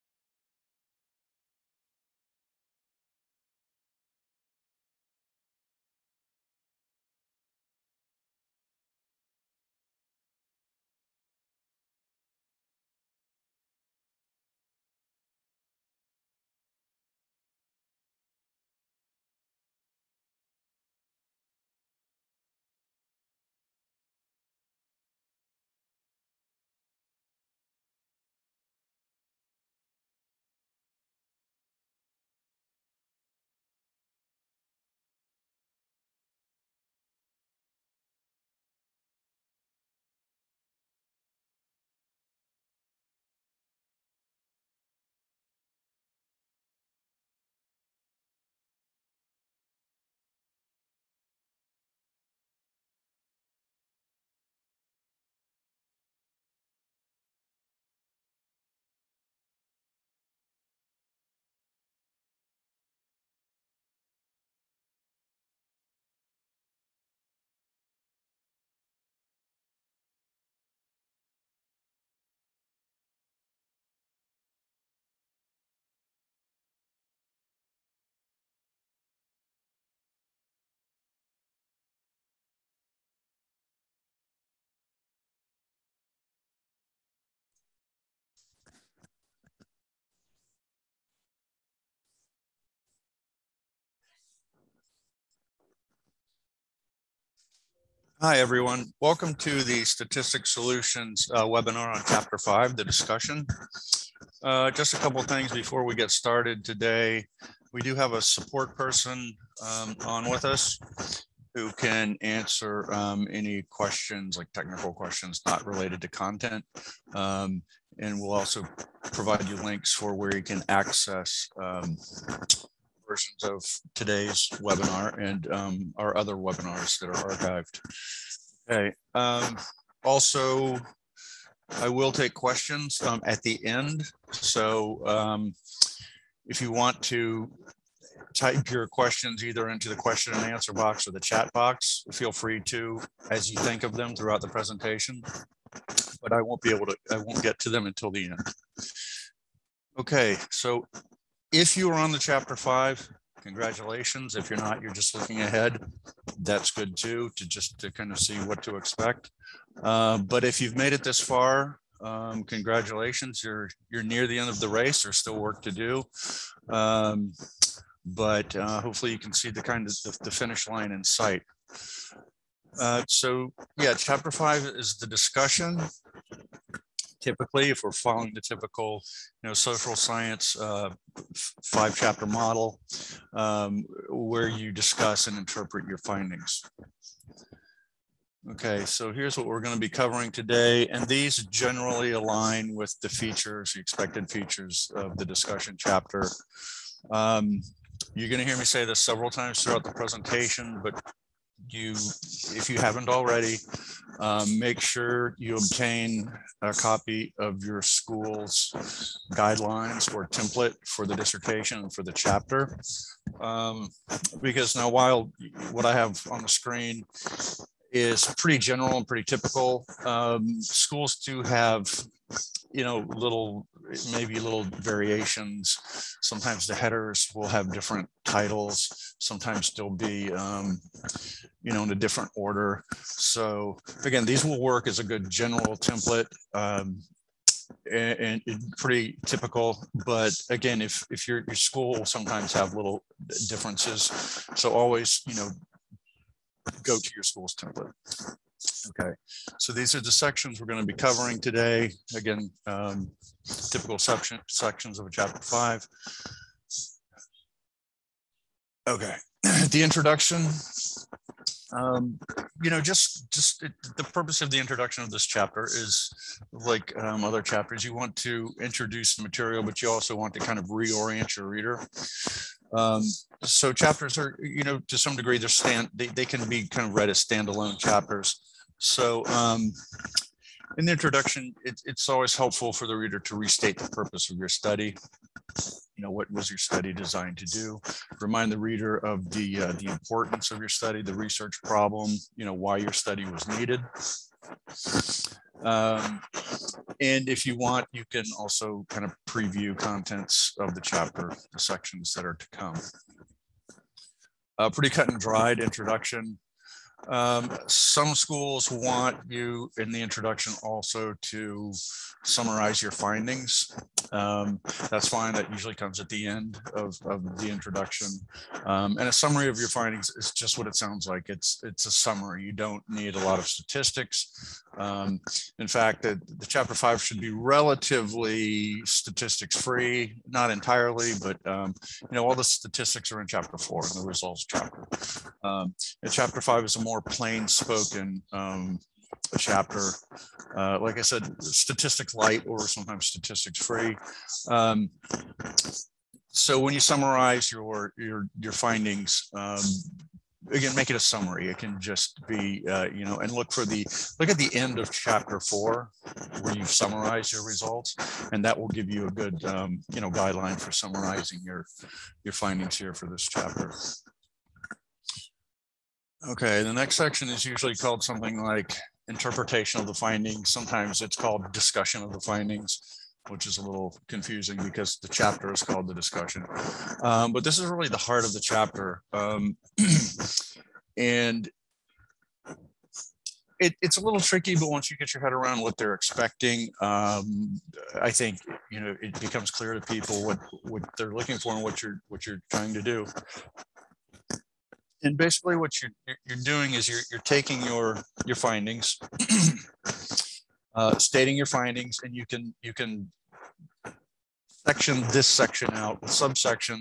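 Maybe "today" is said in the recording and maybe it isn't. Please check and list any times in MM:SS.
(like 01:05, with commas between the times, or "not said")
01:46, 02:03, 03:10, 04:11.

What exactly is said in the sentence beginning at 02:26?
But I won't be able to, I won't get to them until the end.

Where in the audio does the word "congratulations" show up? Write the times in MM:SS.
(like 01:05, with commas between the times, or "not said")
02:33, 02:42.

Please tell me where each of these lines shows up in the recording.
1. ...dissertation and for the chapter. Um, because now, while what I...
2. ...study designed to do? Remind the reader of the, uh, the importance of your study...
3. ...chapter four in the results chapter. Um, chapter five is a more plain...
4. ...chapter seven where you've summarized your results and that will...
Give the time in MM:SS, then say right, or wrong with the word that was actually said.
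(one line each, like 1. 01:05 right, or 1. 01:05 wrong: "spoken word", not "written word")
1. 03:31 right
2. 04:46 right
3. 05:33 right
4. 05:54 wrong: "four", not "seven".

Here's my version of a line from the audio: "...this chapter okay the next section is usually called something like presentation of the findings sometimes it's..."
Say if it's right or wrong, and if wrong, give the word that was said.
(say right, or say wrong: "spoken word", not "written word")
wrong: "interpretation", not "presentation".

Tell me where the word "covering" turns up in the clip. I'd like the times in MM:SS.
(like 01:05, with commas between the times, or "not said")
03:09, 04:10.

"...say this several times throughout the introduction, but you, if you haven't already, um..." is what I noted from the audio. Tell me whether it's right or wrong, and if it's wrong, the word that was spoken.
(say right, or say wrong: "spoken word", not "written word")
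wrong: "presentation", not "introduction".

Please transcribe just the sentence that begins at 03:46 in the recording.
Sometimes the headers will have different titles.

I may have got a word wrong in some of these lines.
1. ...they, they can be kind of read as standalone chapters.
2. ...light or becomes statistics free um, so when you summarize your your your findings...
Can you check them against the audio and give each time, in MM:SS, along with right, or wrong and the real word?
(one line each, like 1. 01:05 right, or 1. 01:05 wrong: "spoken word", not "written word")
1. 04:35 right
2. 05:42 wrong: "sometimes", not "becomes".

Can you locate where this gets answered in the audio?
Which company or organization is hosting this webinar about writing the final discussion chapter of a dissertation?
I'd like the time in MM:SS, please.
01:39.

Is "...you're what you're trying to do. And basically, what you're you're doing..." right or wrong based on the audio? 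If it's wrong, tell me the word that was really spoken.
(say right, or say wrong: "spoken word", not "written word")
right.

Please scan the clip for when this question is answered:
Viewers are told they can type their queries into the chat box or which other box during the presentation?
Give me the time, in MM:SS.
02:19.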